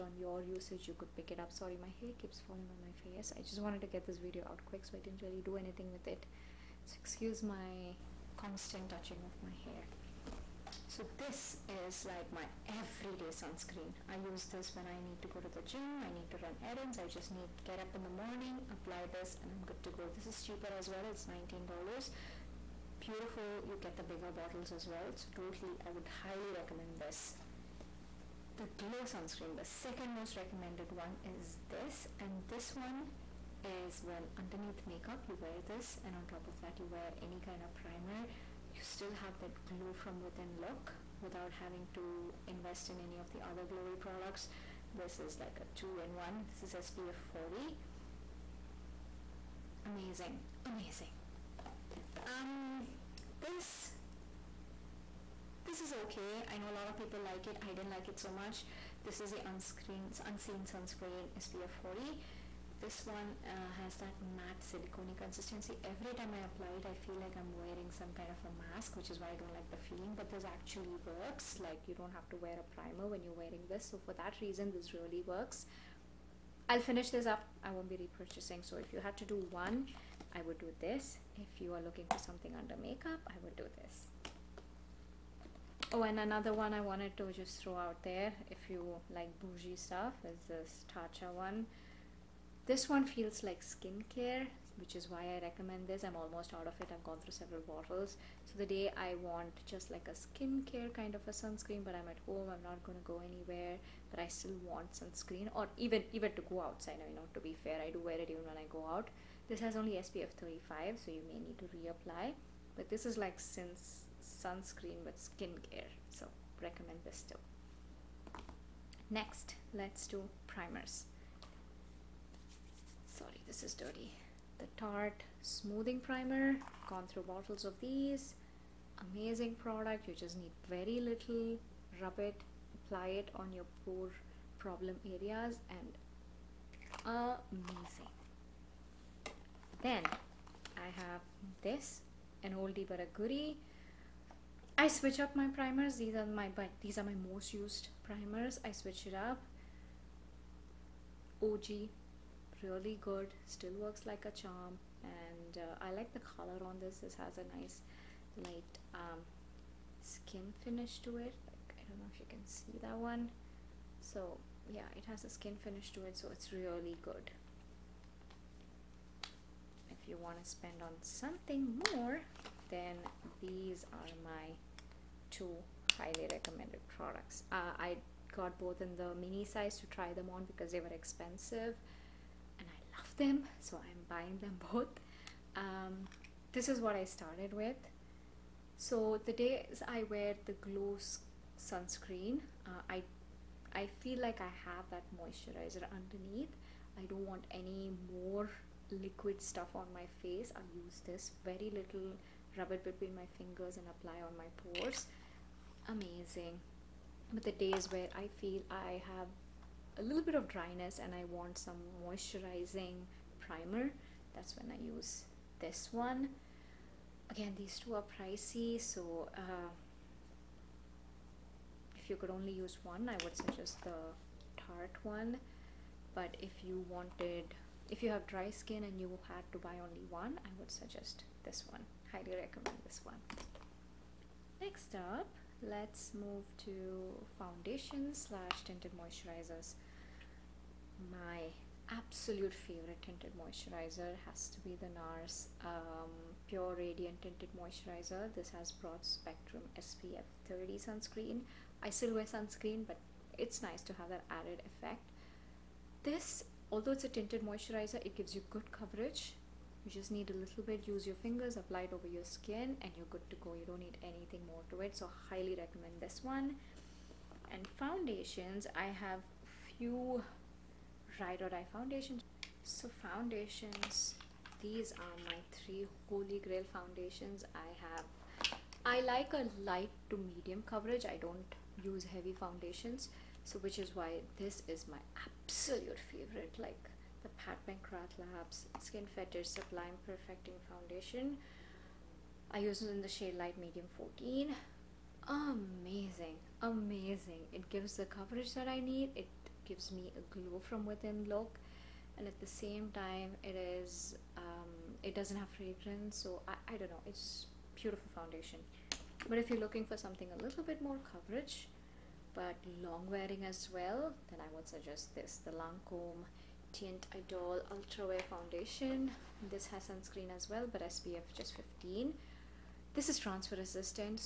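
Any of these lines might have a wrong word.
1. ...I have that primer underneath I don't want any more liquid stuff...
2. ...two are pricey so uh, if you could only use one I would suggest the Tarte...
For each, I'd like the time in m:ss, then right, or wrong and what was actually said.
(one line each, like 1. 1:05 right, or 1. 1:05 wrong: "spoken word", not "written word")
1. 3:14 wrong: "moisturizer", not "primer"
2. 3:37 right.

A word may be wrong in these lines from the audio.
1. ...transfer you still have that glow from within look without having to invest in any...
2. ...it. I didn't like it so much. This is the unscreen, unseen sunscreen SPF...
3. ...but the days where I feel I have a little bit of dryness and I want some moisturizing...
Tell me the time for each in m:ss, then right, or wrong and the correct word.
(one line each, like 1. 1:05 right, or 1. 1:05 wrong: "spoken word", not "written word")
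1. 0:37 wrong: "primer", not "transfer"
2. 0:57 right
3. 3:27 right.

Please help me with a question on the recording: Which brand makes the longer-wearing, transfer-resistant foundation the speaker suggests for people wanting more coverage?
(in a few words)
Lancome.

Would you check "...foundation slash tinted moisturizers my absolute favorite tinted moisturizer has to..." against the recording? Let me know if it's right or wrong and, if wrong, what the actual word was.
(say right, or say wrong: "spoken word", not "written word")
right.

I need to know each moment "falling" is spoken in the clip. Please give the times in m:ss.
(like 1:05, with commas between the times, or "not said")
0:02.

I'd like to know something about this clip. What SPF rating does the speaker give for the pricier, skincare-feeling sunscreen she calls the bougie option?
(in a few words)
SPF 35.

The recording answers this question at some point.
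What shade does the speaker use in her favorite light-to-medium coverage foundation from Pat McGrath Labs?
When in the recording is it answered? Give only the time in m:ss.
4:53.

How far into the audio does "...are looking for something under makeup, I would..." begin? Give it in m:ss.
1:21.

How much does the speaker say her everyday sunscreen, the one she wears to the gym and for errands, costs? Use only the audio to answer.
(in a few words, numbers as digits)
$19.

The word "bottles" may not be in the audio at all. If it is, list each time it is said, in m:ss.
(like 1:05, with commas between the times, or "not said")
0:24, 1:37, 2:07.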